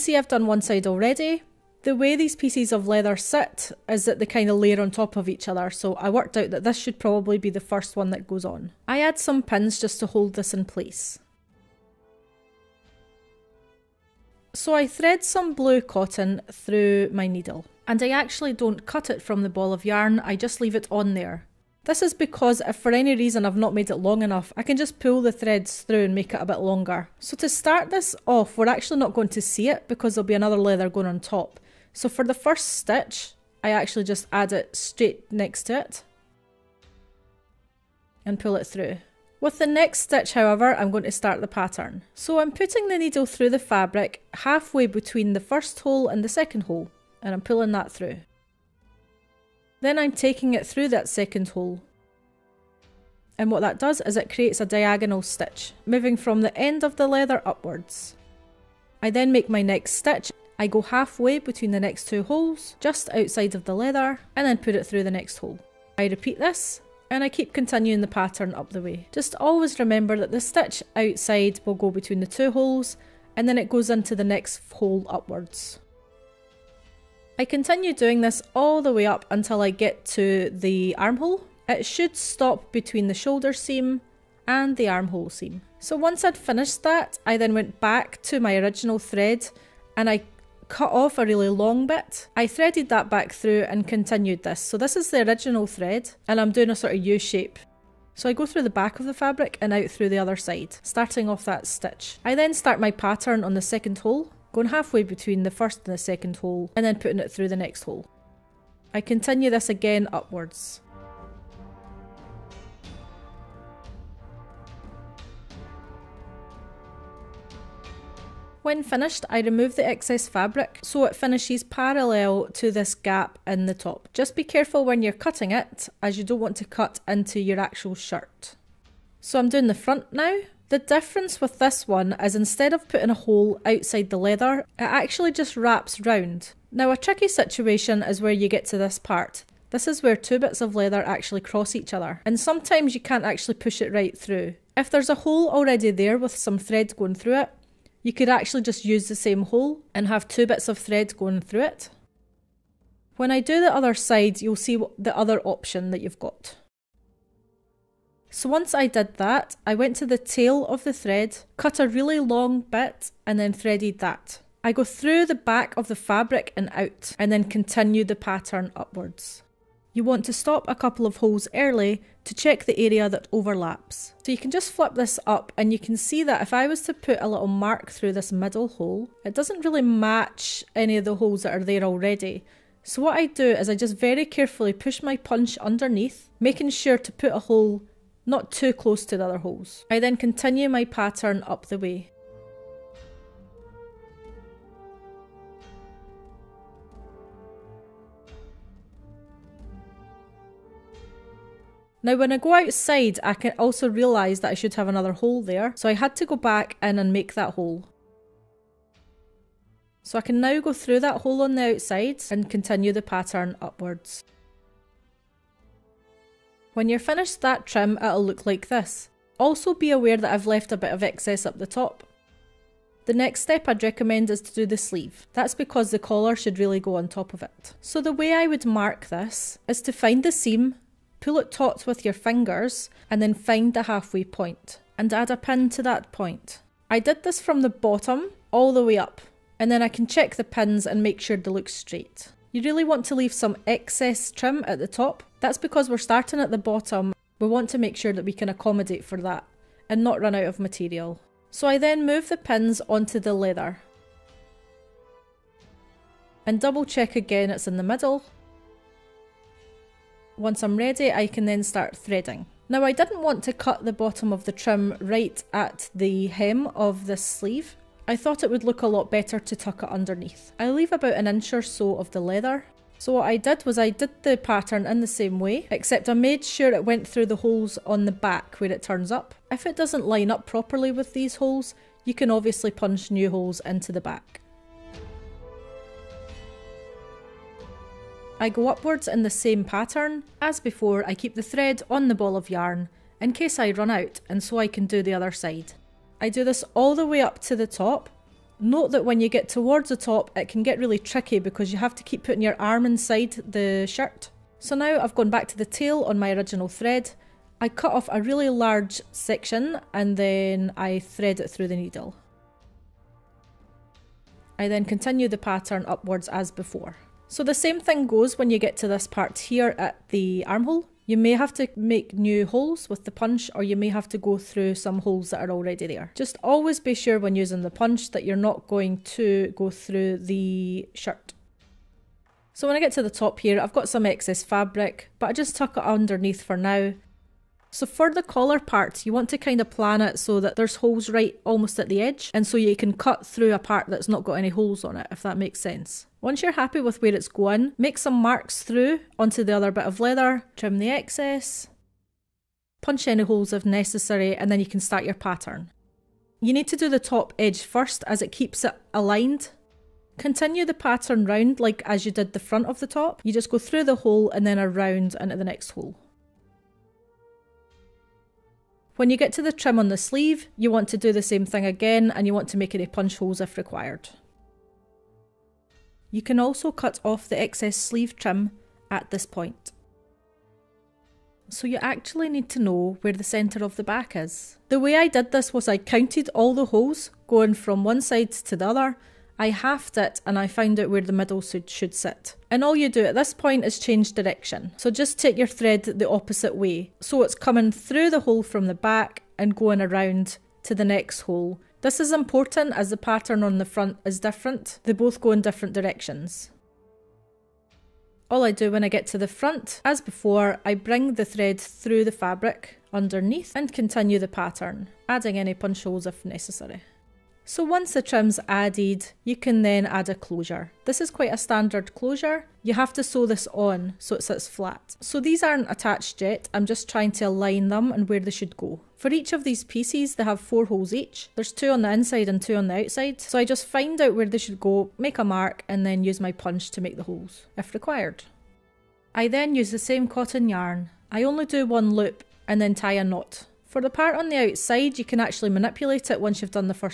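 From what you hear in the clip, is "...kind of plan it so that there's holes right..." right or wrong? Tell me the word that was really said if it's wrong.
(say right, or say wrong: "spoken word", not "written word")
right.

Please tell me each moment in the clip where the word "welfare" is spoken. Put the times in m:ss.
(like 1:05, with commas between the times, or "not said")
not said.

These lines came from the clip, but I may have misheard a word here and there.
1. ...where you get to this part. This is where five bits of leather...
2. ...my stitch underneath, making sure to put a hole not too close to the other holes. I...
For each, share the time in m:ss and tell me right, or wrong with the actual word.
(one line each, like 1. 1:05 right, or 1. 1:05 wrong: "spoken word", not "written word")
1. 2:18 wrong: "two", not "five"
2. 3:05 wrong: "punch", not "stitch".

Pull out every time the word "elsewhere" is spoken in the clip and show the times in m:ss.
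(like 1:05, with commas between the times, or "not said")
not said.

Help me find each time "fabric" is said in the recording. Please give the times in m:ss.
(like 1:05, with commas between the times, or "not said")
0:43, 1:39, 2:00, 2:45, 5:34, 6:52.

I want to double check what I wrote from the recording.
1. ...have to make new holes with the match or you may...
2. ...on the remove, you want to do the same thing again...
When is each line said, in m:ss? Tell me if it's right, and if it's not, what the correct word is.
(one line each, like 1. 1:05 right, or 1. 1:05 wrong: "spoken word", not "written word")
1. 5:21 wrong: "punch", not "match"
2. 6:09 wrong: "sleeve", not "remove".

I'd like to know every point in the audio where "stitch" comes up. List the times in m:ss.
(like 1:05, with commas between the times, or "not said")
0:32, 0:40, 0:55, 0:59, 1:10, 1:41.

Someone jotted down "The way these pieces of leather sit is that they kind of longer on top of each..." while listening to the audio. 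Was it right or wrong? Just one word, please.
wrong.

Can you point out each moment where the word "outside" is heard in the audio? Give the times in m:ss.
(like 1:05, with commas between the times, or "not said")
1:03, 1:10, 2:13, 3:22, 3:31, 7:12, 7:24.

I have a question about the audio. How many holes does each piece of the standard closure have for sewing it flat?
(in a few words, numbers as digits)
4.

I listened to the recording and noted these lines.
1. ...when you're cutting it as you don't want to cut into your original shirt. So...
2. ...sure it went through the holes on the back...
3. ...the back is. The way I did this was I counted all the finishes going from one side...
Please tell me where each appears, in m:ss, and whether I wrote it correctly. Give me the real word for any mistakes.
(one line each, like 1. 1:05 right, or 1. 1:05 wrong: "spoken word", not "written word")
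1. 2:04 wrong: "actual", not "original"
2. 4:36 right
3. 6:23 wrong: "holes", not "finishes".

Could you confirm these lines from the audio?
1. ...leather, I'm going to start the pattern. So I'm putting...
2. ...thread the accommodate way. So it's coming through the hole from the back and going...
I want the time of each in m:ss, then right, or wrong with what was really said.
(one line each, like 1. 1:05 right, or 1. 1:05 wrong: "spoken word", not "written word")
1. 0:40 wrong: "however", not "leather"
2. 6:35 wrong: "opposite", not "accommodate".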